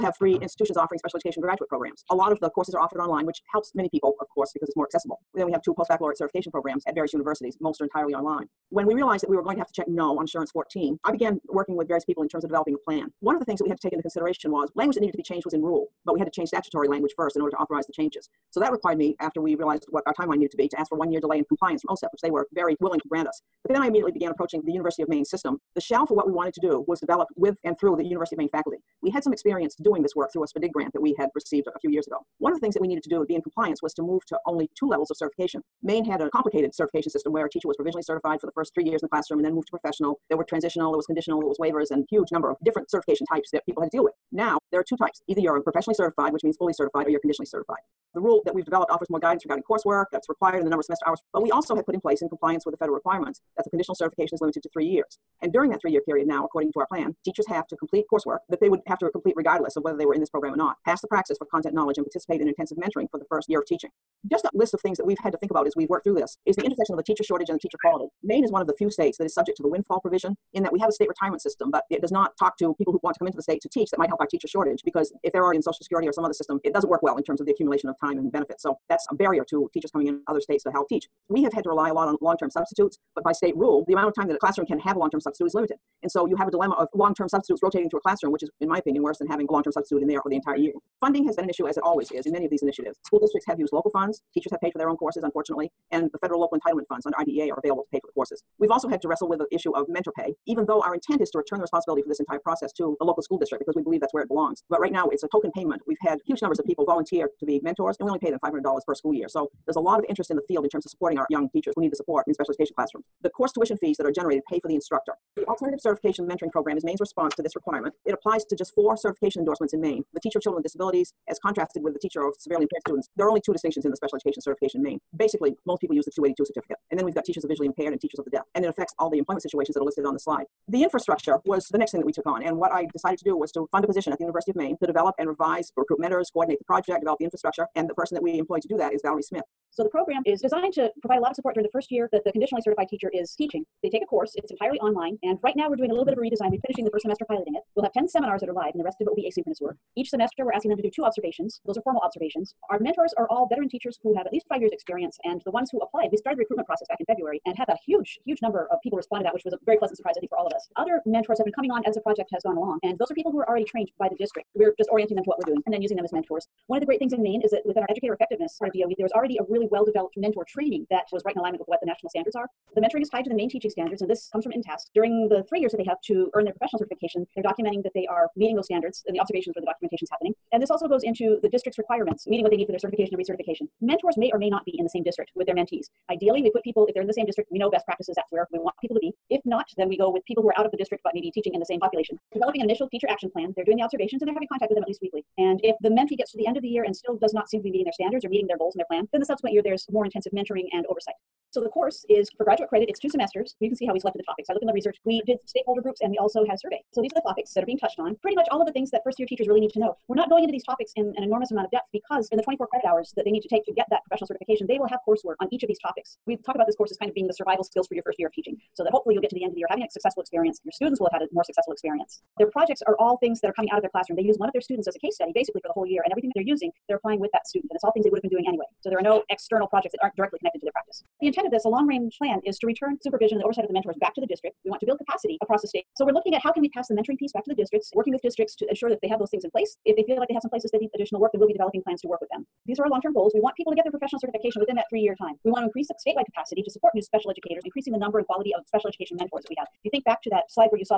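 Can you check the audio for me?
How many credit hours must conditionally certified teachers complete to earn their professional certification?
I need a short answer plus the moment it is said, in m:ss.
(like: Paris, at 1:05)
24, at 3:32.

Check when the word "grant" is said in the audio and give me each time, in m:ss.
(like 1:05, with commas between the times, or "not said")
0:23, 0:30.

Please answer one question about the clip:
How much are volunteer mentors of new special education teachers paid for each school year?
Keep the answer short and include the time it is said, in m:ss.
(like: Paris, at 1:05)
$500, at 1:48.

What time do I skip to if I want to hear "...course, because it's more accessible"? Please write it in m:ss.
0:04.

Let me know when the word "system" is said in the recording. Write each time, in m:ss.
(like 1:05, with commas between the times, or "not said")
0:25, 0:37, 1:11, 1:16.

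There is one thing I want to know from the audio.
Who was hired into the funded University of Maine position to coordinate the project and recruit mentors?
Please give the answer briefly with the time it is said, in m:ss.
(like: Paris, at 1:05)
Valerie Smith, at 2:19.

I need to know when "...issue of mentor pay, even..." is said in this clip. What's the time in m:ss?
1:39.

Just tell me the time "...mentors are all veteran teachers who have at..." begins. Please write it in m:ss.
2:32.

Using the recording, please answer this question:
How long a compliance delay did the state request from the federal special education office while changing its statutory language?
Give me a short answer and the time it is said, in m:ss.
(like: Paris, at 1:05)
1 year, at 0:20.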